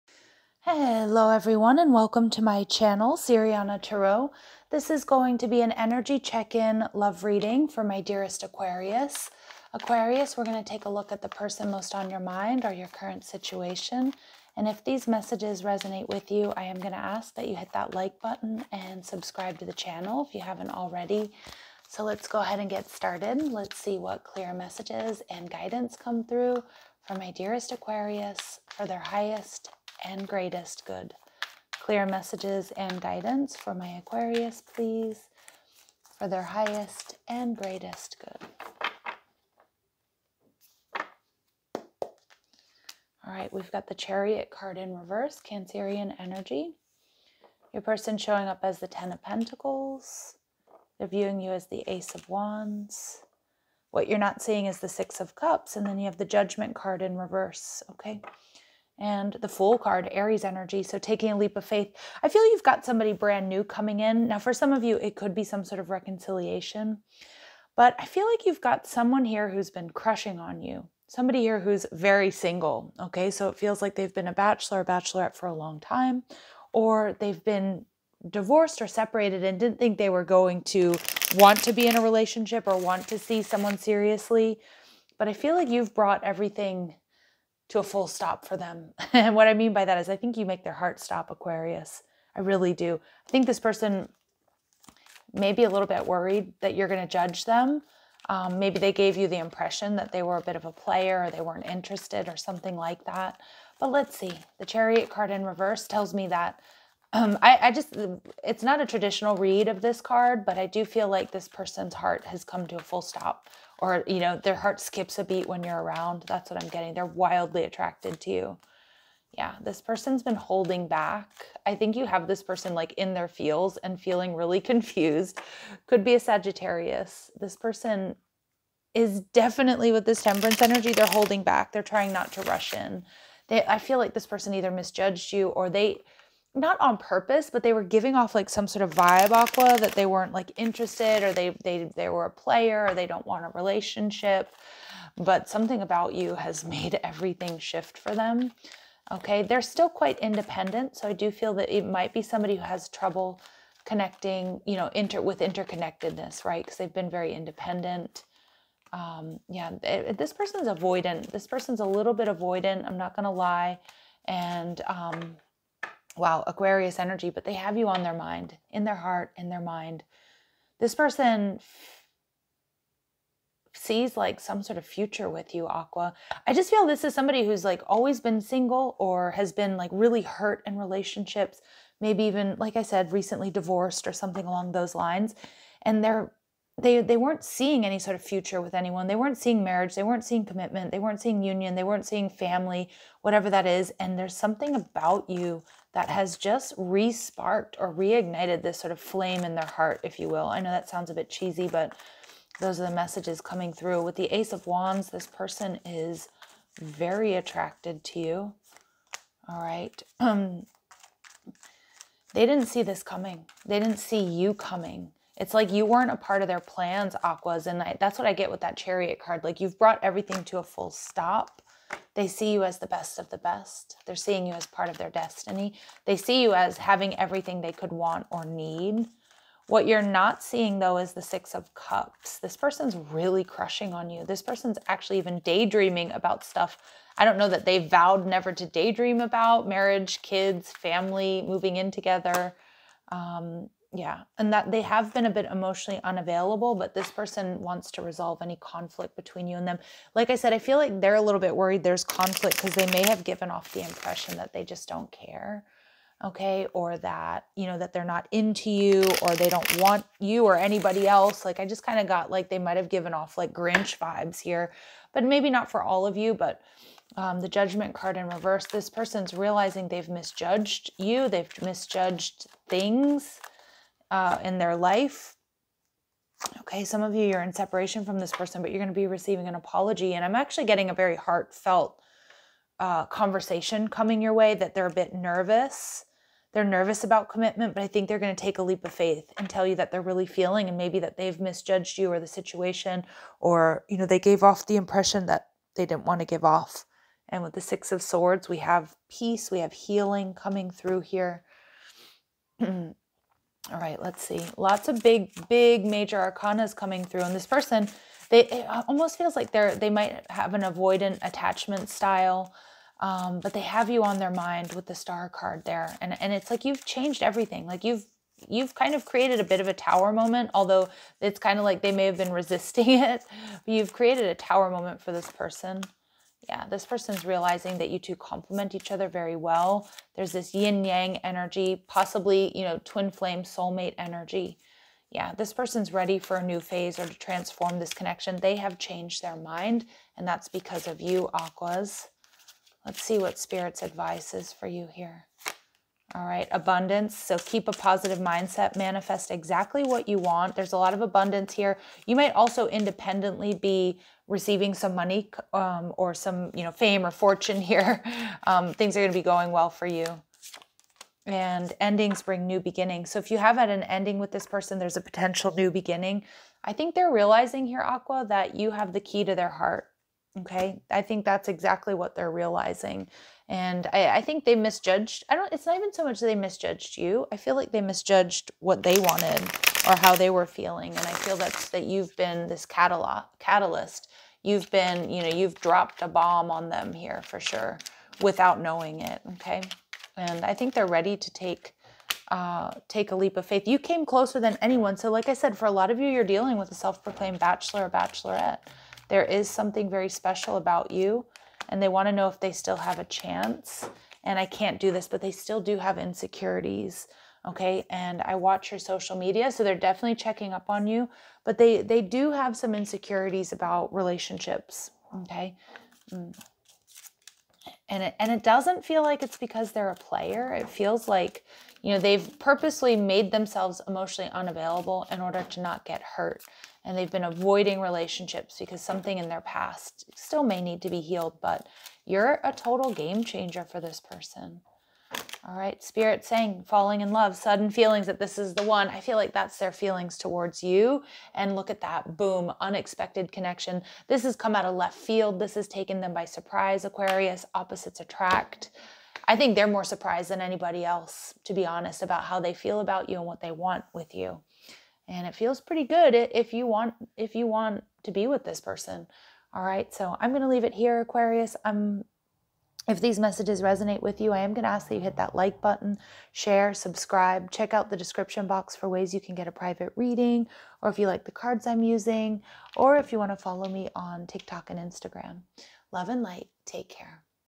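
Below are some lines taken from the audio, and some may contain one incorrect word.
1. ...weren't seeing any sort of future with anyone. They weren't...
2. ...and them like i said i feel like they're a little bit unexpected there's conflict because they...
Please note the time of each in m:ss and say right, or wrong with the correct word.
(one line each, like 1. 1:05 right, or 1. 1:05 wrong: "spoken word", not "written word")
1. 3:07 right
2. 4:09 wrong: "worried", not "unexpected".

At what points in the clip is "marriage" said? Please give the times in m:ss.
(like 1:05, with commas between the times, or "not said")
3:09, 3:59.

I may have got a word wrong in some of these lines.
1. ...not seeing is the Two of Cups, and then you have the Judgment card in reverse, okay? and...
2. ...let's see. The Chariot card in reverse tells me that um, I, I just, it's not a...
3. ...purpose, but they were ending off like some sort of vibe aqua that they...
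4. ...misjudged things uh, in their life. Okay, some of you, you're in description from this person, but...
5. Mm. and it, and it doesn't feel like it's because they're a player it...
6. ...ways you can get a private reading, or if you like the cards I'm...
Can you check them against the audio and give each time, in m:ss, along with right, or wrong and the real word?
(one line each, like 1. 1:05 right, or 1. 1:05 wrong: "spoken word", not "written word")
1. 0:54 wrong: "Six", not "Two"
2. 1:43 right
3. 2:16 wrong: "giving", not "ending"
4. 4:31 wrong: "separation", not "description"
5. 6:56 right
6. 7:48 right.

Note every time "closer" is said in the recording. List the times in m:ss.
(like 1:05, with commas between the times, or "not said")
6:34.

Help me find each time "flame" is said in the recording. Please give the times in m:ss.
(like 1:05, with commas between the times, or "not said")
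3:18, 5:33.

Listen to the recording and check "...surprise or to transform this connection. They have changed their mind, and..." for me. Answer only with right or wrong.
wrong.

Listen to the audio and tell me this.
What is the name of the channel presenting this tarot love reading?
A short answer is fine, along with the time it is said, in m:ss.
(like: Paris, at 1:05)
Siriana Tarot, at 0:03.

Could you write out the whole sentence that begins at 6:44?
And I can't do this, but they still do have insecurities.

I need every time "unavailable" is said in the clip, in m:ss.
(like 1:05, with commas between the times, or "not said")
4:06, 7:04.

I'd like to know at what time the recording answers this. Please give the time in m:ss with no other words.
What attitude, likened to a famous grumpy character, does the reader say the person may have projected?
4:23.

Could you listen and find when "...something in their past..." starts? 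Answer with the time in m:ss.
7:08.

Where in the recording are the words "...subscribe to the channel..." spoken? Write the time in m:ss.
0:19.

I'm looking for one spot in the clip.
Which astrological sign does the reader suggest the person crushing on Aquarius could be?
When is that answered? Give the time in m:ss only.
2:06.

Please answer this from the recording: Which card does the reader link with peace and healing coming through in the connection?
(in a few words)
Six of Swords.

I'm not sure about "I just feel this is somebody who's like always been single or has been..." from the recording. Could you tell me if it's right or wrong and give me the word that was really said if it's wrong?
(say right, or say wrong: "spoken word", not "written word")
right.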